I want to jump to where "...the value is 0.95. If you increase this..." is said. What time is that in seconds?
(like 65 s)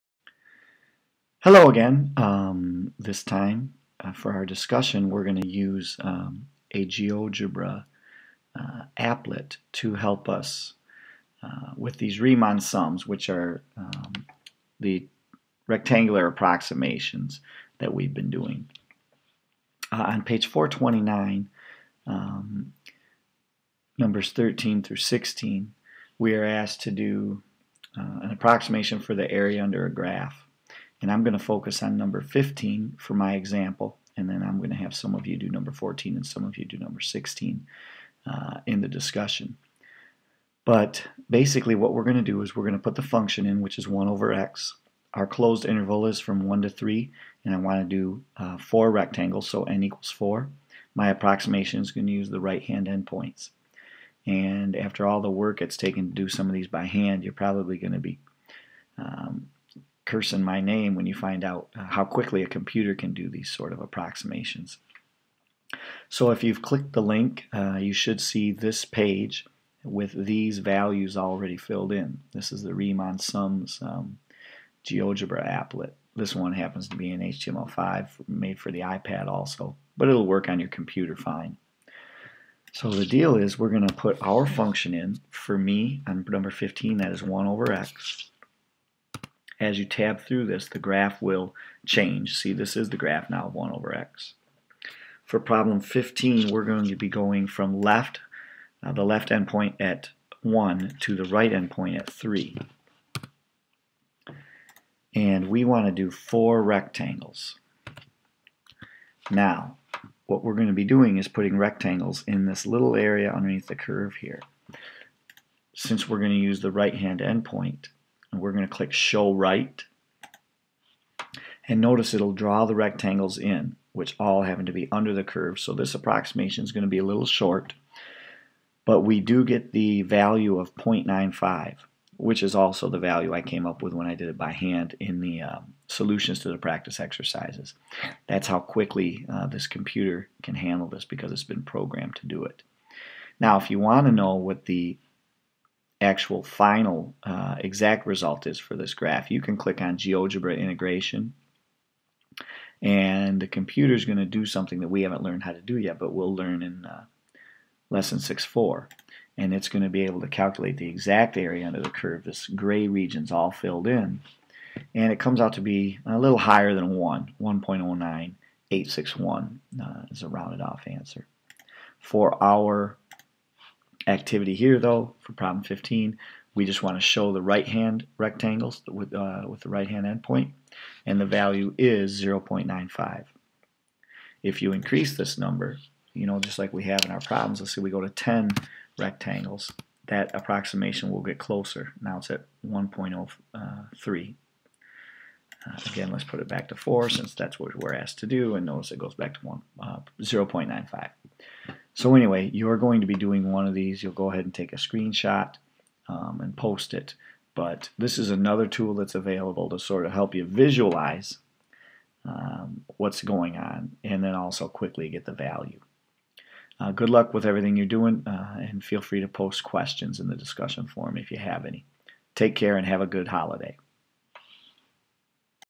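181 s.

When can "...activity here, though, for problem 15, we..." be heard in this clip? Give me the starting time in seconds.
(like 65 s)
174 s.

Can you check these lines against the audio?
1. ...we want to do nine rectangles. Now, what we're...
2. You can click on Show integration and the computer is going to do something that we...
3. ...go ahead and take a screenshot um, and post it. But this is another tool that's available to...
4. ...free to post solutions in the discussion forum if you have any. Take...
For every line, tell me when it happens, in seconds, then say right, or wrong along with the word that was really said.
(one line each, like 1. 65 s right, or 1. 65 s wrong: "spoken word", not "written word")
1. 105 s wrong: "four", not "nine"
2. 149 s wrong: "GeoGebra", not "Show"
3. 204 s right
4. 219 s wrong: "questions", not "solutions".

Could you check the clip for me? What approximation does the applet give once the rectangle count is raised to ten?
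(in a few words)
1.03.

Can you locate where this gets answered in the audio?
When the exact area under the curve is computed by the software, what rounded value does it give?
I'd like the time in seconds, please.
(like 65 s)
167 s.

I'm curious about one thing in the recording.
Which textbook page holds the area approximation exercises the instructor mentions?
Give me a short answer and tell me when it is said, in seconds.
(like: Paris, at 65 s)
429, at 20 s.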